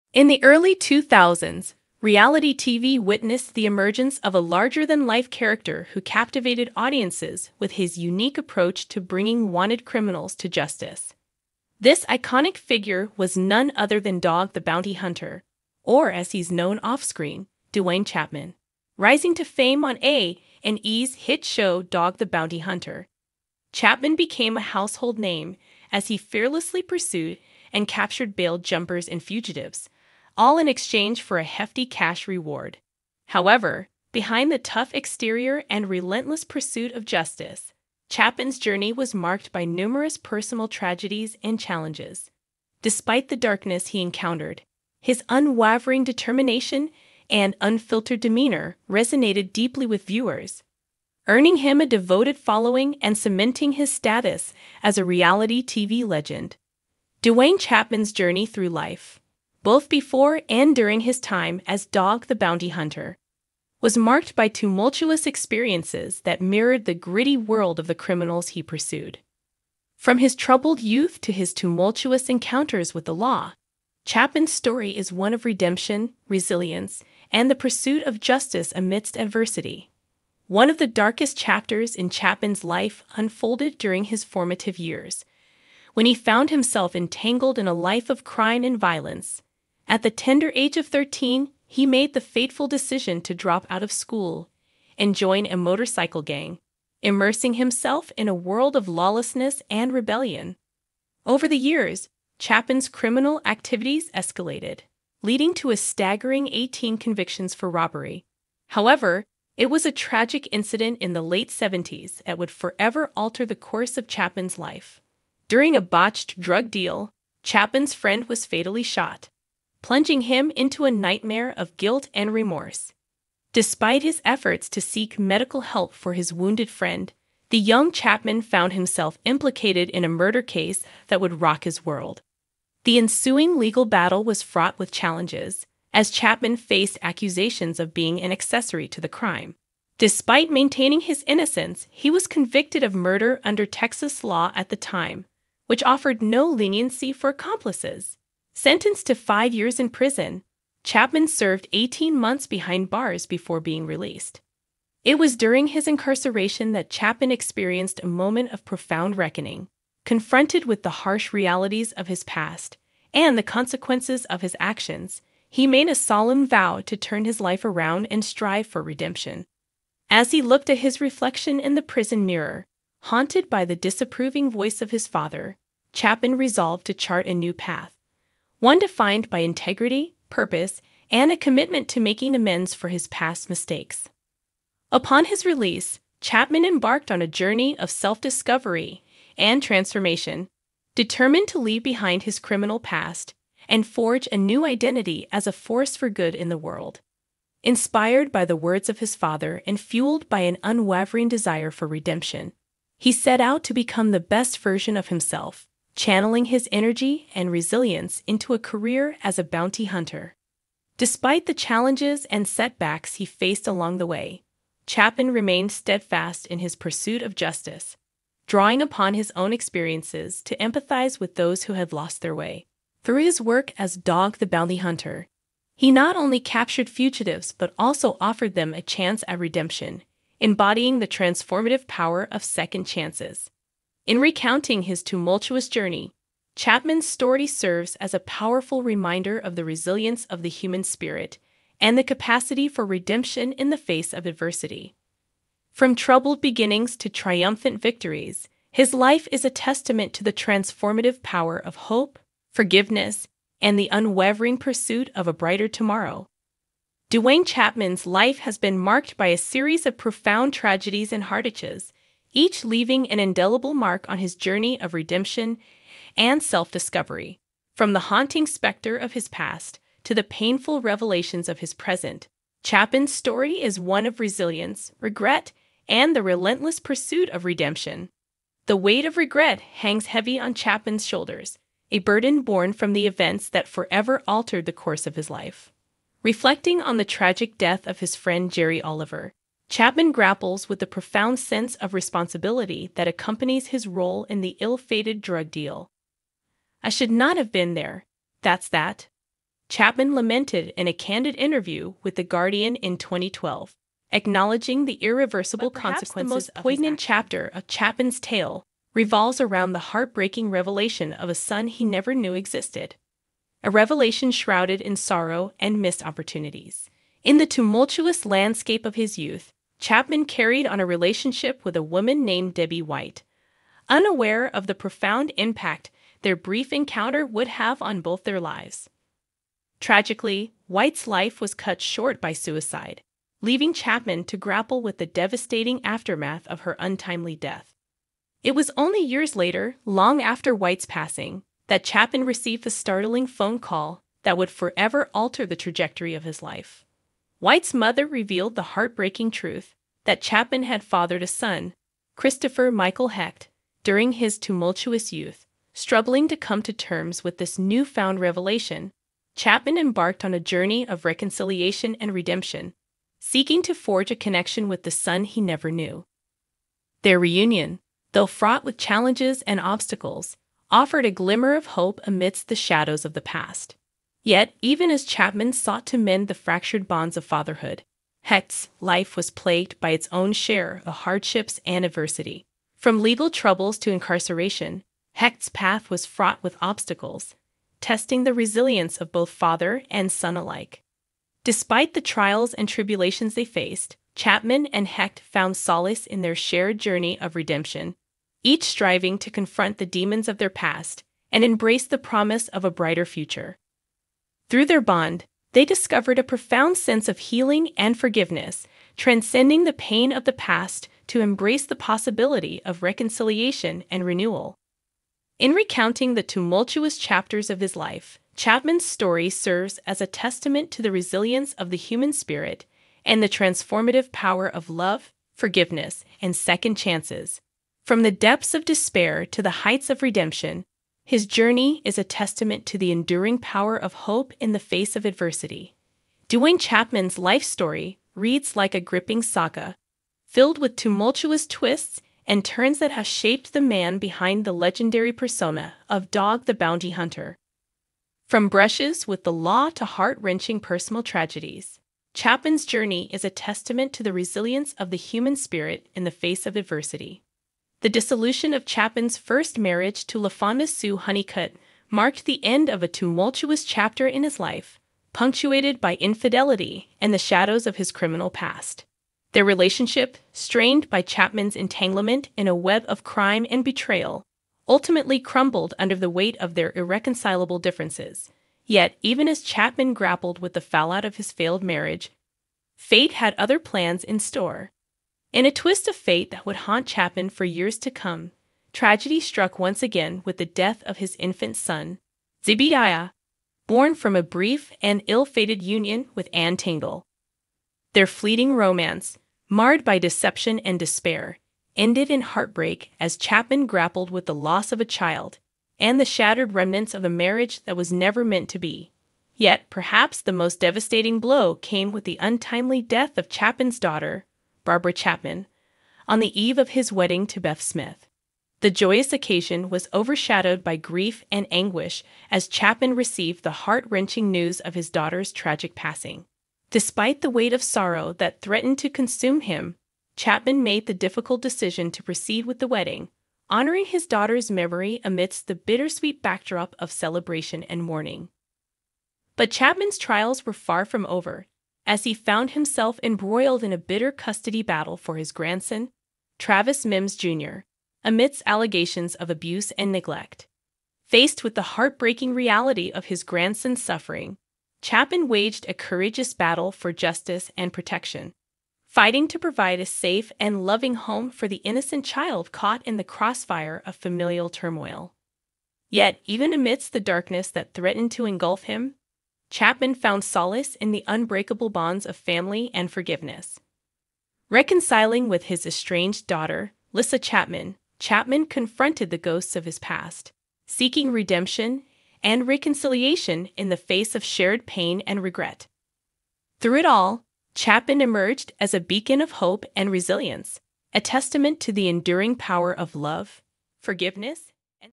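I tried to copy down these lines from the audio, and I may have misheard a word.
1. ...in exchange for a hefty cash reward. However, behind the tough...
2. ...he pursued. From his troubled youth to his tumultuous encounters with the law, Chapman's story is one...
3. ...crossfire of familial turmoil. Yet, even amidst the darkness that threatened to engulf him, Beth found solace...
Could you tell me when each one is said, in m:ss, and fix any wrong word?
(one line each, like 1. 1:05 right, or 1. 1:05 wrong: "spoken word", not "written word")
1. 0:30 right
2. 1:08 right
3. 9:23 wrong: "Chapman", not "Beth".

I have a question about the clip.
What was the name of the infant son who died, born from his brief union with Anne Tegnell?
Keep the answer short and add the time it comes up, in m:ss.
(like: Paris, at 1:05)
Zebidiah, at 8:12.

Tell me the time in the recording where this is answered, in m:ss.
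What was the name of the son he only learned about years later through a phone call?
5:52.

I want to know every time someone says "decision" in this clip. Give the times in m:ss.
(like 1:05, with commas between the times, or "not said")
1:32, 8:51.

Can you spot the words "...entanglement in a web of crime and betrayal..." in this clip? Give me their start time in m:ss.
7:51.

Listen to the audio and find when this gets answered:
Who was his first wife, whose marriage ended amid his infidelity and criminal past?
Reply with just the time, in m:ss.
7:40.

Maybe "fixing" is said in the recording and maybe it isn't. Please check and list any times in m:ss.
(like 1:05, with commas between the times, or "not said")
not said.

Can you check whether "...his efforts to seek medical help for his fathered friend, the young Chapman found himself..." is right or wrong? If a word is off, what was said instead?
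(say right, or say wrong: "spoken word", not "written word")
wrong: "wounded", not "fathered".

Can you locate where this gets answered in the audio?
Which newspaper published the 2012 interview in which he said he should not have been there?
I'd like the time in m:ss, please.
5:02.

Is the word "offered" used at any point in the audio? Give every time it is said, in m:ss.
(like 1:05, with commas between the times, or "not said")
2:25, 3:48, 6:10.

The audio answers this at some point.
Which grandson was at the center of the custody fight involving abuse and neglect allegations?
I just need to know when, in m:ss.
9:06.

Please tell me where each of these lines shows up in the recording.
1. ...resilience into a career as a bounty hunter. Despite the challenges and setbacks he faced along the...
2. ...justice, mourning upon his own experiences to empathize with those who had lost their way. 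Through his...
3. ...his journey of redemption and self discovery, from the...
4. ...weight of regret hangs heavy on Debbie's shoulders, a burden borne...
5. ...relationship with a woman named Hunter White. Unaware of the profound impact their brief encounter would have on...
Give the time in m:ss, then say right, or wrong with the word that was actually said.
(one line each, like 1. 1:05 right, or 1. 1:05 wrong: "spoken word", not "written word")
1. 3:27 right
2. 3:37 wrong: "drawing", not "mourning"
3. 4:24 right
4. 4:38 wrong: "Chapman", not "Debbie"
5. 5:20 wrong: "Debbie", not "Hunter".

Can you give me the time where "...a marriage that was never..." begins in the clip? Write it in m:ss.
8:27.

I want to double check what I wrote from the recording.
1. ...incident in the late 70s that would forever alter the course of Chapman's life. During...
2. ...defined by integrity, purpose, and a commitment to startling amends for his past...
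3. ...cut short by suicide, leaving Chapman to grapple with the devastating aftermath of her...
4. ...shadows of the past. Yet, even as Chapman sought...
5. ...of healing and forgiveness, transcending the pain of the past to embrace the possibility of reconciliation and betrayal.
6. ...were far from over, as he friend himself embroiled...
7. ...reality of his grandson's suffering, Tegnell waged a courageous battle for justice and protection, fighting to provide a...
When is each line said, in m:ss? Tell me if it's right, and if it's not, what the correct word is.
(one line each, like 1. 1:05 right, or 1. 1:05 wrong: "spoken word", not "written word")
1. 1:50 right
2. 2:58 wrong: "making", not "startling"
3. 5:31 right
4. 6:12 right
5. 6:47 wrong: "renewal", not "betrayal"
6. 9:00 wrong: "found", not "friend"
7. 9:12 wrong: "Chapman", not "Tegnell".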